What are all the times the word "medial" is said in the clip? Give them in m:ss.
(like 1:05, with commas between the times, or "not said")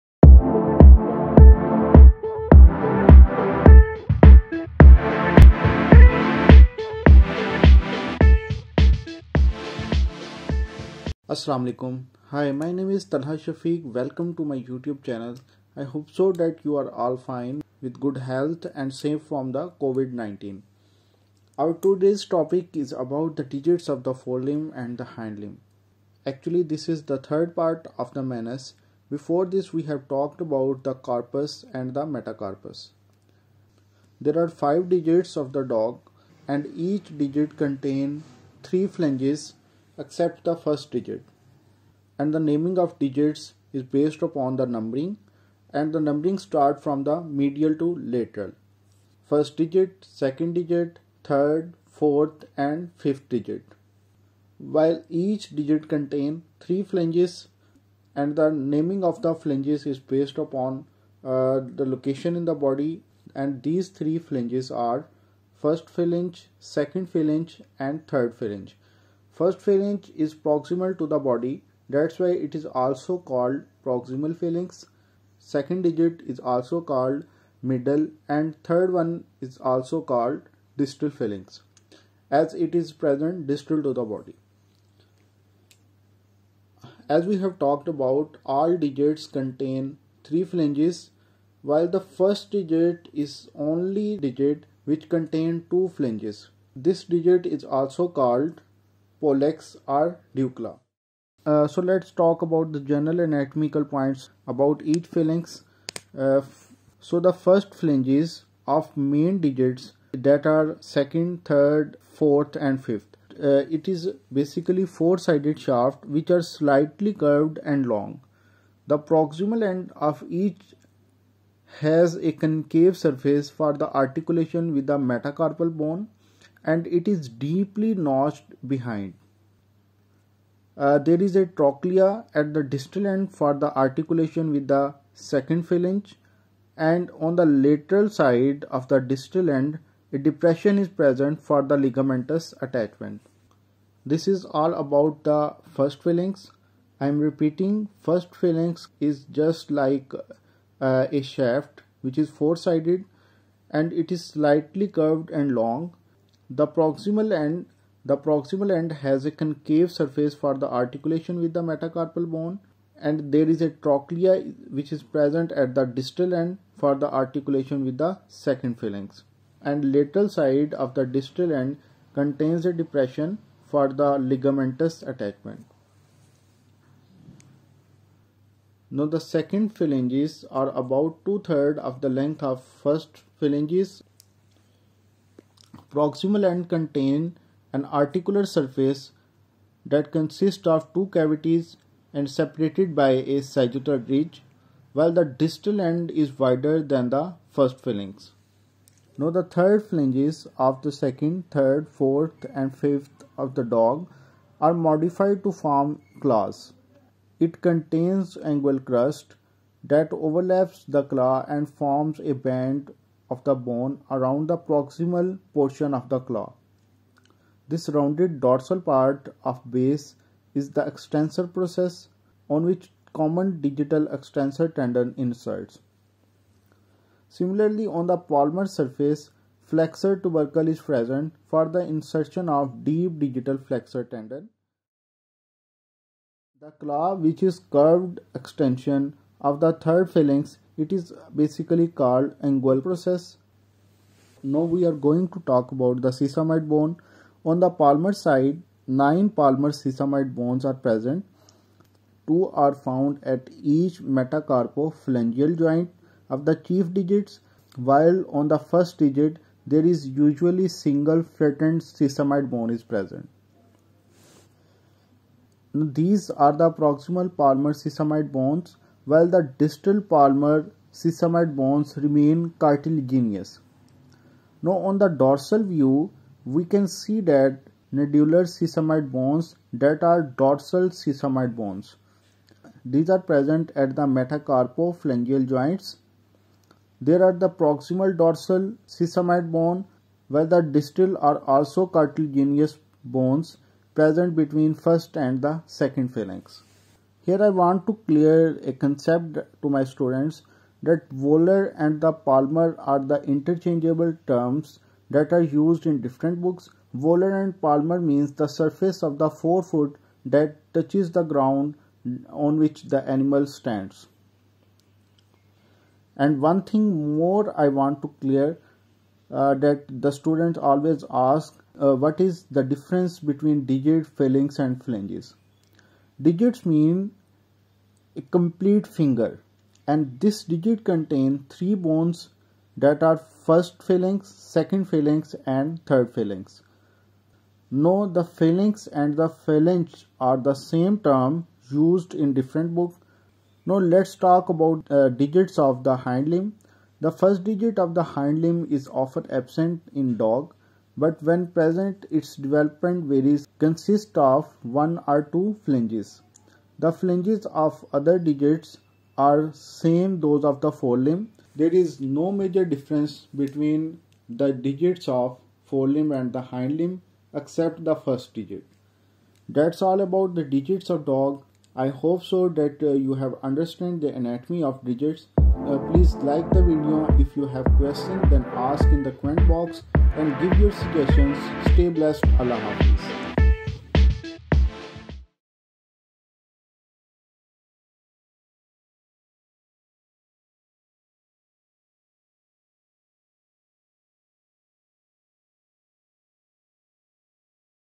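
0:47.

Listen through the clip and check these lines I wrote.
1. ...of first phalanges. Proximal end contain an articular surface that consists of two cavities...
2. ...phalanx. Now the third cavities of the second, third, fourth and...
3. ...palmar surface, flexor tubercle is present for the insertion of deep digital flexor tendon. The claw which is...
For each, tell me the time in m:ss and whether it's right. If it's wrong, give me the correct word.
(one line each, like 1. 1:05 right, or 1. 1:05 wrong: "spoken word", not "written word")
1. 3:02 right
2. 3:17 wrong: "phalanges", not "cavities"
3. 3:48 right.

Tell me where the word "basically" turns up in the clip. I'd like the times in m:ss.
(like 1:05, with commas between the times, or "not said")
1:54, 4:01.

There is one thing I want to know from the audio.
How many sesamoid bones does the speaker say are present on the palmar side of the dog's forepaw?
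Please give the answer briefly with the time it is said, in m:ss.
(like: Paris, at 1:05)
9, at 4:08.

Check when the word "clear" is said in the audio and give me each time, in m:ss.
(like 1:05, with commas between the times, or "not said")
4:58, 5:18.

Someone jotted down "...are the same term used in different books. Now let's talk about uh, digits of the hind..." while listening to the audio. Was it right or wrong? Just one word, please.
right.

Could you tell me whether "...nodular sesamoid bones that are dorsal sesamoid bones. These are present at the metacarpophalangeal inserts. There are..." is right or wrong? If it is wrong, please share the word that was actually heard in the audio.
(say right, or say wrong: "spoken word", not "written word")
wrong: "joints", not "inserts".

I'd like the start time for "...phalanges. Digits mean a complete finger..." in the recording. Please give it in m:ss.
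5:24.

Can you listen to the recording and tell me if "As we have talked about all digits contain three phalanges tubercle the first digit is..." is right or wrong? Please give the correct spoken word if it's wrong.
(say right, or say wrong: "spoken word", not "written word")
wrong: "while", not "tubercle".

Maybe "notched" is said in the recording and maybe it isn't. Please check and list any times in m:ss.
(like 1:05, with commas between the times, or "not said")
2:07.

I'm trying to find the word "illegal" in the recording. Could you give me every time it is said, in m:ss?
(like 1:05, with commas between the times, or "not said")
not said.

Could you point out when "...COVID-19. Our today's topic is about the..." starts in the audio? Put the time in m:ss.
0:19.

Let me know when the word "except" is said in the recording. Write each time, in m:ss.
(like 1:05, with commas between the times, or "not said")
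0:40, 6:07.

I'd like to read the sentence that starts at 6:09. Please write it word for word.
That's all about the digits of dog.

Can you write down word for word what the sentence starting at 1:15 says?
Second digit is also called middle and third one is also called distal phalanx as it is present distal to the body.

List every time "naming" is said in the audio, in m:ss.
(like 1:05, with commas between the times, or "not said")
0:42, 0:58.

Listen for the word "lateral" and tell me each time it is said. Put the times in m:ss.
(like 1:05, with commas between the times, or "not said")
0:48, 2:17, 2:49.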